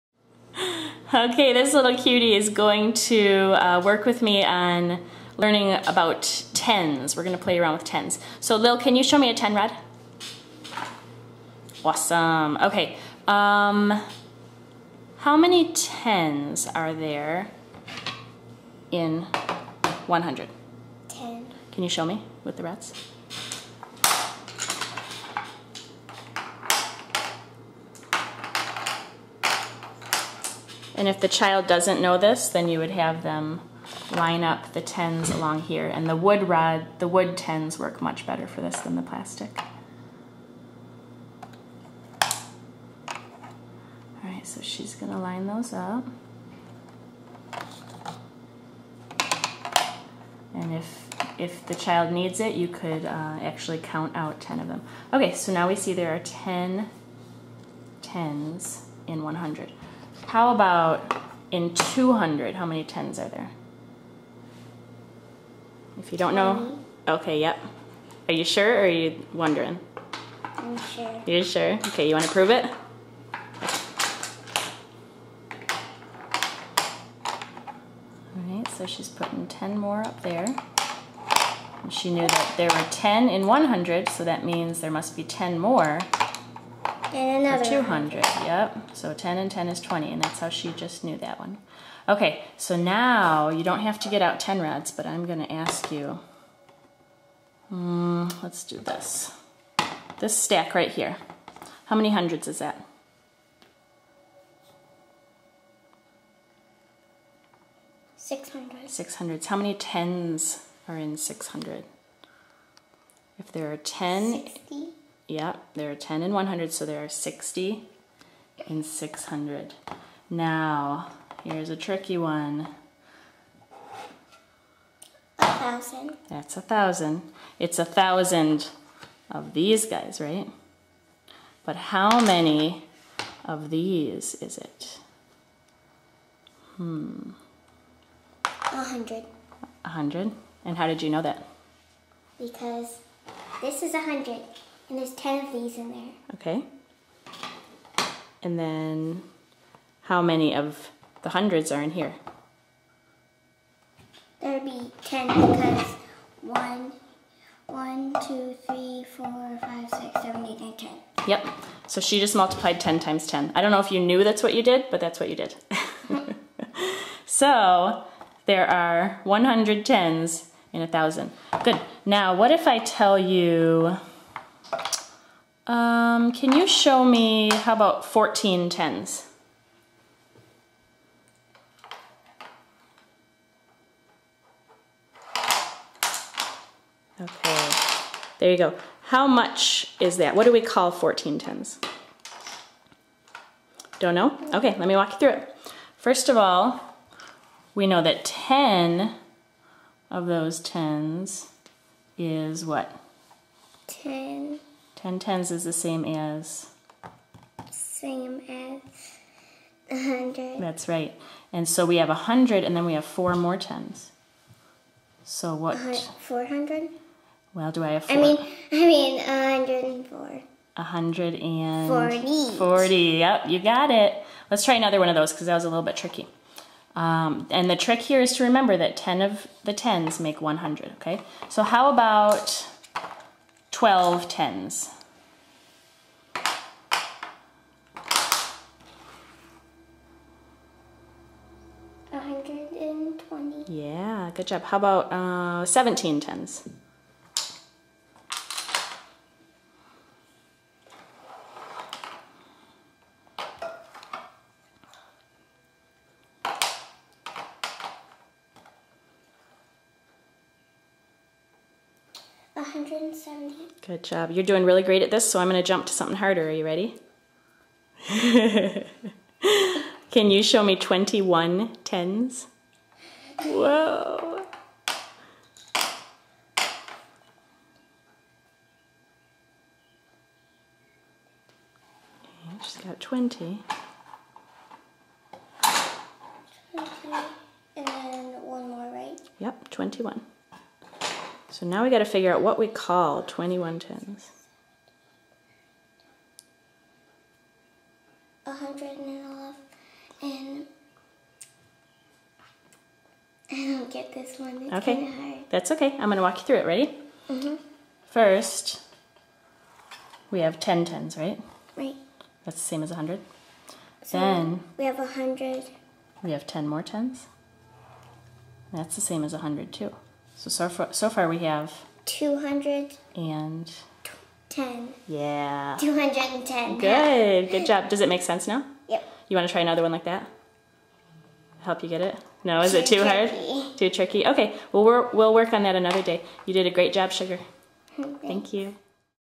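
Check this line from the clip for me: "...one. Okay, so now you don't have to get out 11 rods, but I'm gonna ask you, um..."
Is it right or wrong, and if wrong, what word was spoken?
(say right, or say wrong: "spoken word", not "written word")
wrong: "10", not "11".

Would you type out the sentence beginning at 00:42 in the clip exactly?
All right, so she's gonna line those up.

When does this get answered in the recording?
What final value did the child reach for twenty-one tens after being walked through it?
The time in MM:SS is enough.
05:25.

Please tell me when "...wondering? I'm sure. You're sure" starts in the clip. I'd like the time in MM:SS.
01:09.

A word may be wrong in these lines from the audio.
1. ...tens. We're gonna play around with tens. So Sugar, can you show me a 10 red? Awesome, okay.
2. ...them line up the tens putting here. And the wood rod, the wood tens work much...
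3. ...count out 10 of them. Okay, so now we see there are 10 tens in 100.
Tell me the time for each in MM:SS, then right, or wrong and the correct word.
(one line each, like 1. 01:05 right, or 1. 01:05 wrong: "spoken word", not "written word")
1. 00:06 wrong: "Lil", not "Sugar"
2. 00:33 wrong: "along", not "putting"
3. 00:53 right.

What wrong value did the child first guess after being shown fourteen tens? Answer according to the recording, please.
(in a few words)
400.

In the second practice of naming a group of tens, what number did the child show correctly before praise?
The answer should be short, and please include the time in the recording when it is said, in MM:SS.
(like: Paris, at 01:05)
170, at 04:22.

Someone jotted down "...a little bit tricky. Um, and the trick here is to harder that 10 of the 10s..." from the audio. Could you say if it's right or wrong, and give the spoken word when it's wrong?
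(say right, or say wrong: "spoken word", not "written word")
wrong: "remember", not "harder".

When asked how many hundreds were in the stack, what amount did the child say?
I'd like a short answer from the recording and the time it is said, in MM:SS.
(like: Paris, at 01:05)
600, at 01:48.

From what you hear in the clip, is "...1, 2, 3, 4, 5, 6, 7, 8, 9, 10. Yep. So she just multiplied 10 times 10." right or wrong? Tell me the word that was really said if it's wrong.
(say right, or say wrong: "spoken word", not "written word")
right.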